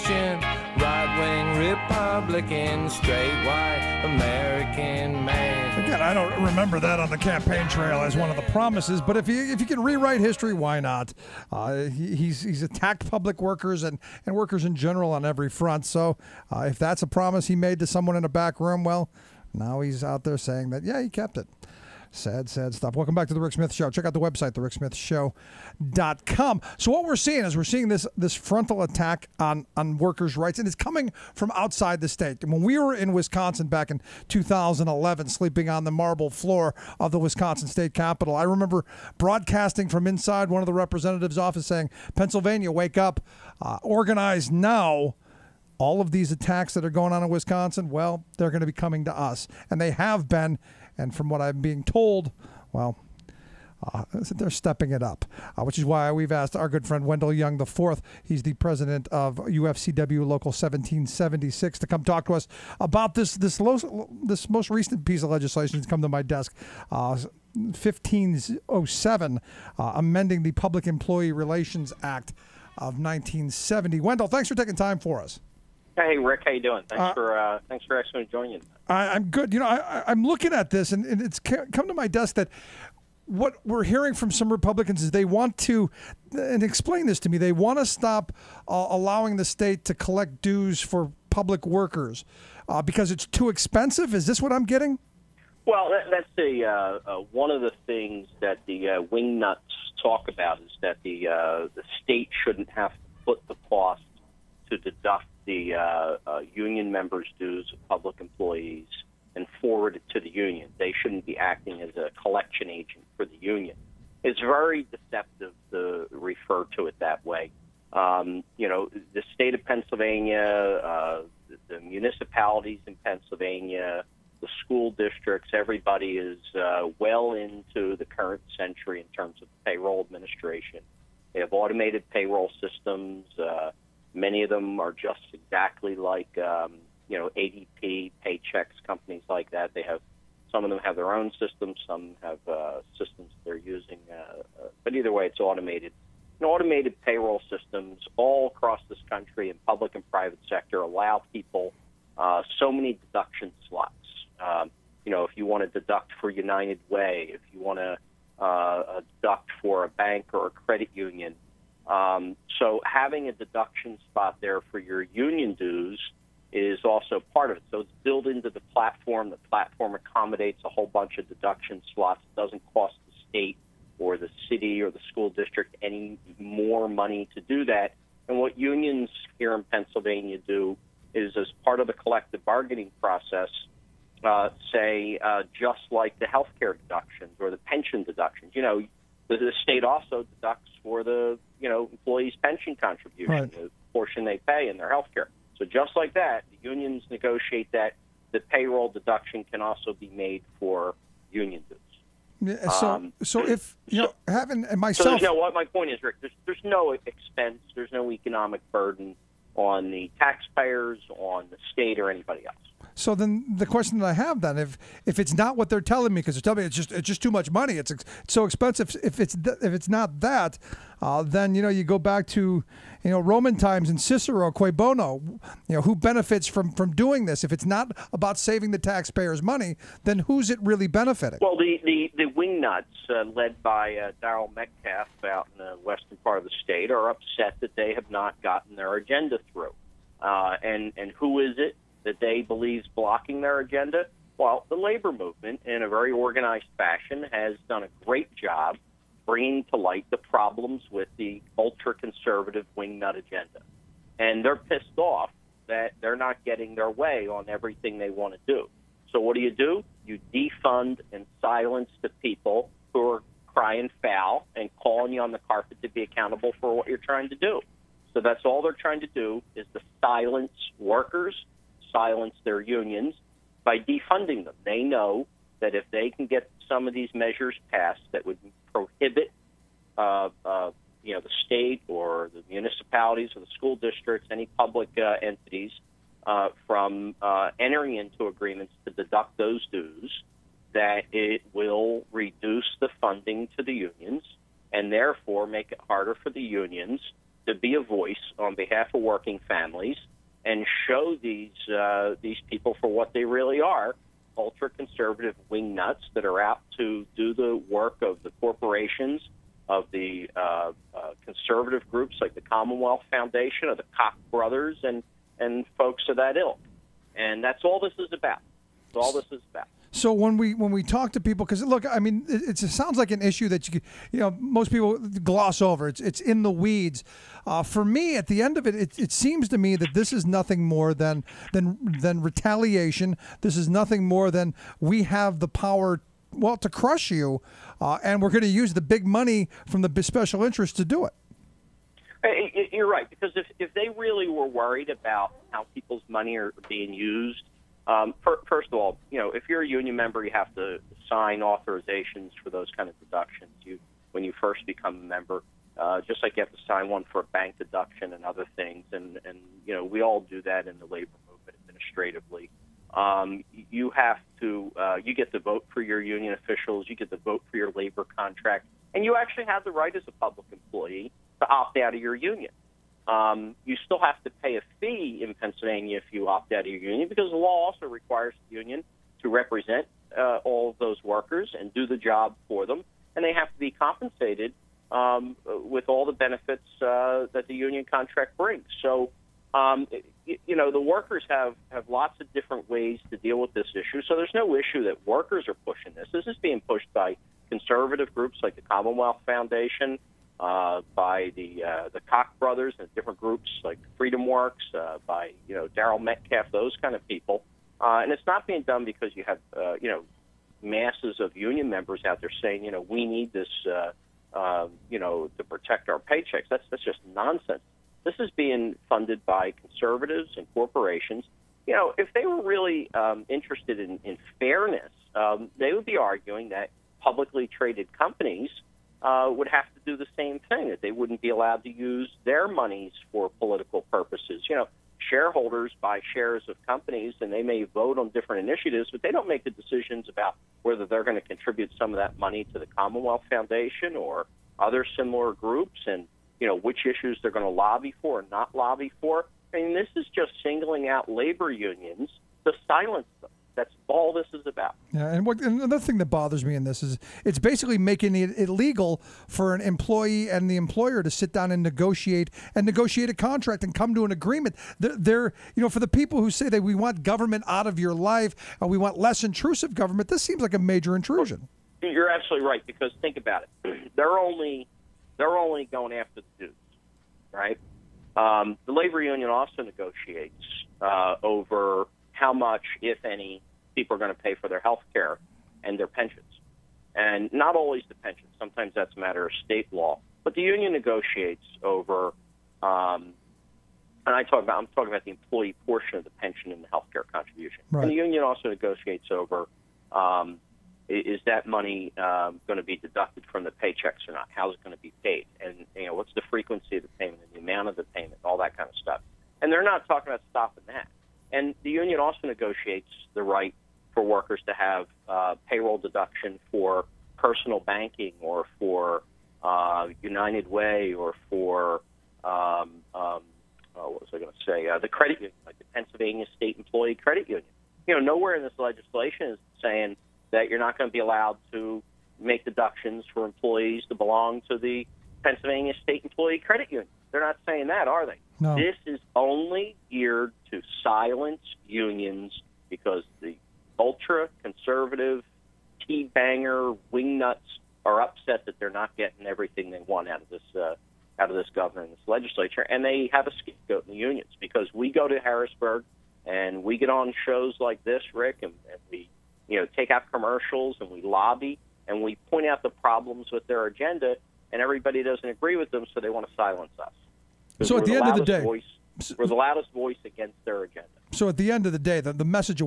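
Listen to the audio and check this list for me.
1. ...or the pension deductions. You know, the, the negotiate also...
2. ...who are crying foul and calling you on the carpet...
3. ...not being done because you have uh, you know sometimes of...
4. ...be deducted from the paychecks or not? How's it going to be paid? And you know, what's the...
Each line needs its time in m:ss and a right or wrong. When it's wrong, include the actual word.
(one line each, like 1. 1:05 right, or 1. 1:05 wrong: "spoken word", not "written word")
1. 3:07 wrong: "state", not "negotiate"
2. 4:22 right
3. 6:48 wrong: "masses", not "sometimes"
4. 8:22 right.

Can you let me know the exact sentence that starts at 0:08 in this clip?
But if you if you can rewrite history, why not?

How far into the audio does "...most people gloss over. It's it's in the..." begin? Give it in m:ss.
5:24.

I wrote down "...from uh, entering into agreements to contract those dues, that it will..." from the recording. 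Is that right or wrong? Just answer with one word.
wrong.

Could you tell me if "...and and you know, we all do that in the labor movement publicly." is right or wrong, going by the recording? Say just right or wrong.
wrong.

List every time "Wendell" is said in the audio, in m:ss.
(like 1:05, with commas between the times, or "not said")
0:57, 1:13.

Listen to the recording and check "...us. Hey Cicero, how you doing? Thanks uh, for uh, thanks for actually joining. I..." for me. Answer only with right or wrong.
wrong.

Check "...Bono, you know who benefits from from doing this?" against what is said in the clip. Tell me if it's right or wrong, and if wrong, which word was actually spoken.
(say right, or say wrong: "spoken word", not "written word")
right.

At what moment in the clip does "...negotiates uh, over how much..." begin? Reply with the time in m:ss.
7:59.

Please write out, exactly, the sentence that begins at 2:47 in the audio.
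So it's built into the platform.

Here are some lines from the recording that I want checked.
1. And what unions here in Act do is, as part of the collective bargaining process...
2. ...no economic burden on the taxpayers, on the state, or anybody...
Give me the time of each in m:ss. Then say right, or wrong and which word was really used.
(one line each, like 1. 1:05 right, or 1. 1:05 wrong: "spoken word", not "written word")
1. 2:58 wrong: "Pennsylvania", not "Act"
2. 3:27 right.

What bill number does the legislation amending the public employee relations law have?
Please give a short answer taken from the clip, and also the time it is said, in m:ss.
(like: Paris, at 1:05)
1507, at 1:07.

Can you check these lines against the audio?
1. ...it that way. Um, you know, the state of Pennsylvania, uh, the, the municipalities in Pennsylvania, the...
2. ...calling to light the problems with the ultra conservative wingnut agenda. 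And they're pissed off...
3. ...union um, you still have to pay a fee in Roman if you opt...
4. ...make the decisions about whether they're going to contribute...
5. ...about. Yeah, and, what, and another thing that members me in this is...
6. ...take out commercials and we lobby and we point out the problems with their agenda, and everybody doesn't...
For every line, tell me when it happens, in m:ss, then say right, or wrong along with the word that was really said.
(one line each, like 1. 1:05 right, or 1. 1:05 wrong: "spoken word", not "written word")
1. 1:56 right
2. 4:09 wrong: "bringing", not "calling"
3. 6:12 wrong: "Pennsylvania", not "Roman"
4. 7:19 right
5. 7:34 wrong: "bothers", not "members"
6. 9:19 right.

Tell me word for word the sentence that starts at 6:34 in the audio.
So there's no issue that workers are pushing this.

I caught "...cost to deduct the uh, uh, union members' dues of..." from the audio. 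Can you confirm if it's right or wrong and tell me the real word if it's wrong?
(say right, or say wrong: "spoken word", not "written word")
right.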